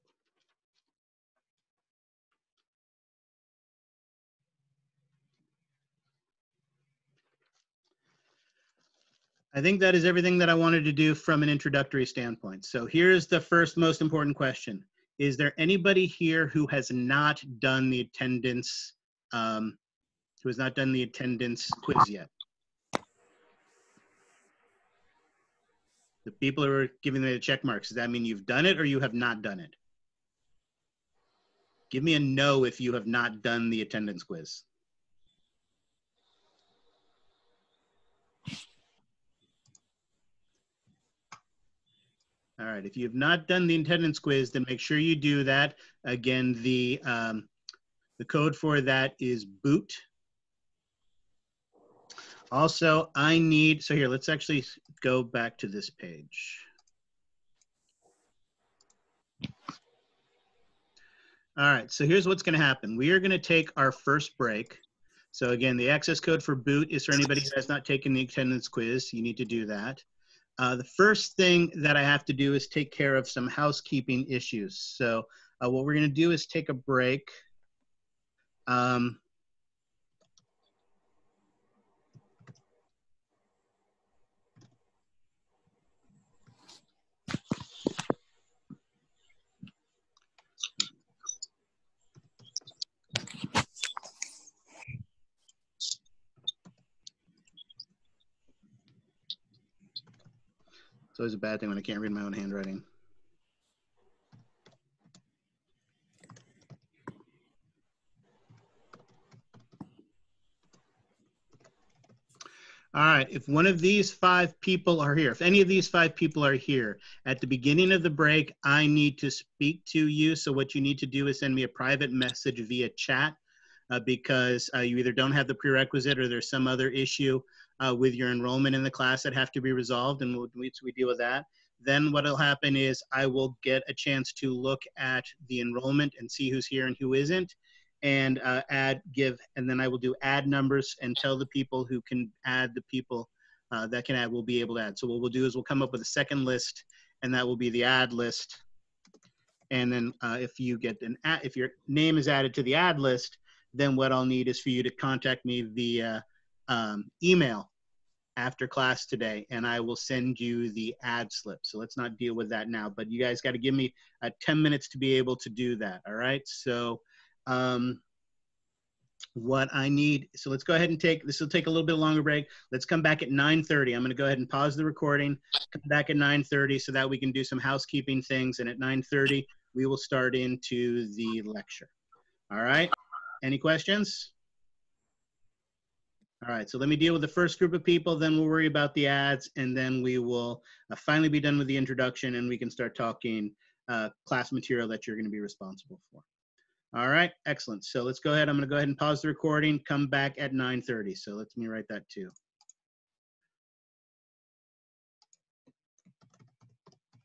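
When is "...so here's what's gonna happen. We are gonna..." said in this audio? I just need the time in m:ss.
1:01.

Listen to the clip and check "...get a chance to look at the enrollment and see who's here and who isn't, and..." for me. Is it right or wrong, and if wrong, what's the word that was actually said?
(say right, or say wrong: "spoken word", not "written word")
right.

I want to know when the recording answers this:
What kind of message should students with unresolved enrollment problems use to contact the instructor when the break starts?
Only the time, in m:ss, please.
2:01.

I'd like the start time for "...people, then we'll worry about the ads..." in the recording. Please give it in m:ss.
3:07.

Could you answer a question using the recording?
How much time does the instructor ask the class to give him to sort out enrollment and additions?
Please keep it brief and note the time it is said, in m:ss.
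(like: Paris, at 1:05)
10 minutes, at 2:44.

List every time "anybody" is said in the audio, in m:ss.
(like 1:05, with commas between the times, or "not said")
0:15, 1:07.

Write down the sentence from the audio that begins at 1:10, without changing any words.
Uh, the first thing that I have to do is take care of some housekeeping issues.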